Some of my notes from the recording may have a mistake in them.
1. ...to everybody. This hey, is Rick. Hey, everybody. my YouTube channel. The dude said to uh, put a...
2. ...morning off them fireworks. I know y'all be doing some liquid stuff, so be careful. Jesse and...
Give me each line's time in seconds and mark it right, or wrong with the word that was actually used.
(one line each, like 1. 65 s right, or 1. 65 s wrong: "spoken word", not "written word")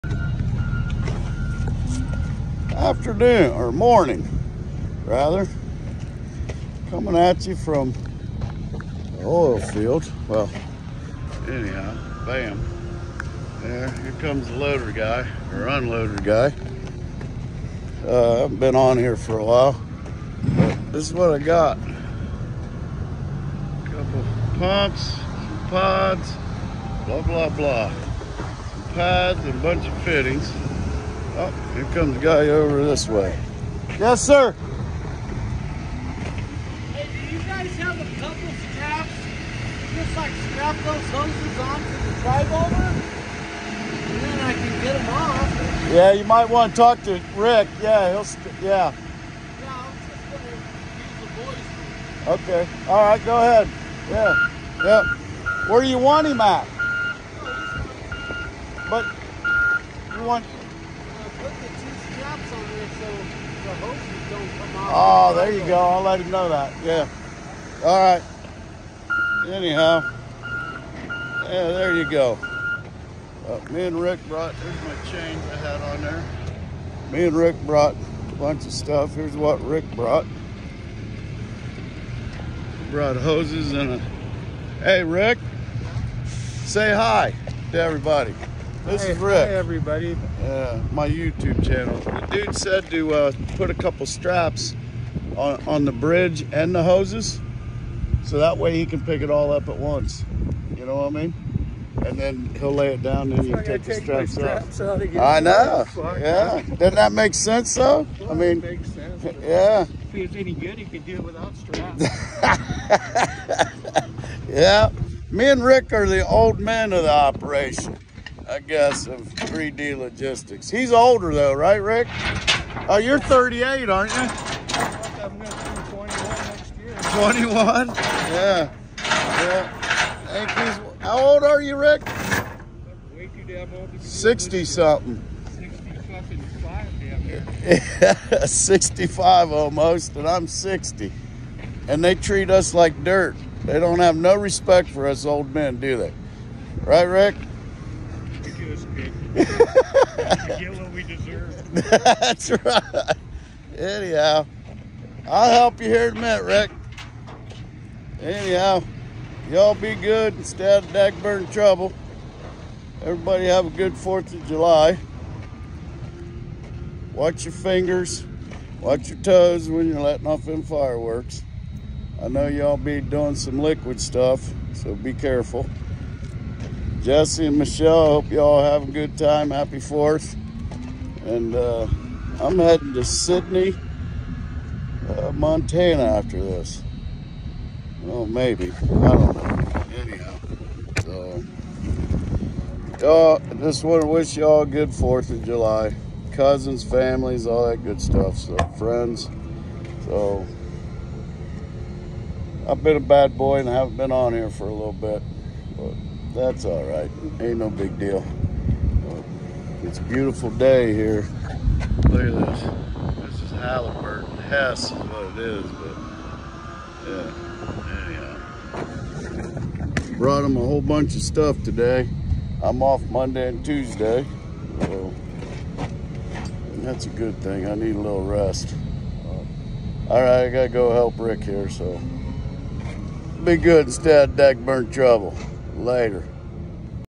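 1. 87 s right
2. 170 s wrong: "letting", not "morning".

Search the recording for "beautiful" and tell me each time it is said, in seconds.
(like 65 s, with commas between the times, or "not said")
210 s.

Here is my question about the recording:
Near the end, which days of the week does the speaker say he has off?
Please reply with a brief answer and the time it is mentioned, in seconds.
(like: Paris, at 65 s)
Monday and Tuesday, at 223 s.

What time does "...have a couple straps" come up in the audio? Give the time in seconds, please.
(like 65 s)
37 s.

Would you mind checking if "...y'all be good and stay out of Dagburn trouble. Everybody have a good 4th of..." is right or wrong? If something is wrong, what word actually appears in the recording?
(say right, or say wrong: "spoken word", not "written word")
right.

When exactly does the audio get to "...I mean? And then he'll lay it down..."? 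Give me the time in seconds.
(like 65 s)
101 s.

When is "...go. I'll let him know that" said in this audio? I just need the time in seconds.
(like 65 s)
65 s.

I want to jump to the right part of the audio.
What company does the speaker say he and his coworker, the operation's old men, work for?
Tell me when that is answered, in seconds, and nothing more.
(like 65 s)
119 s.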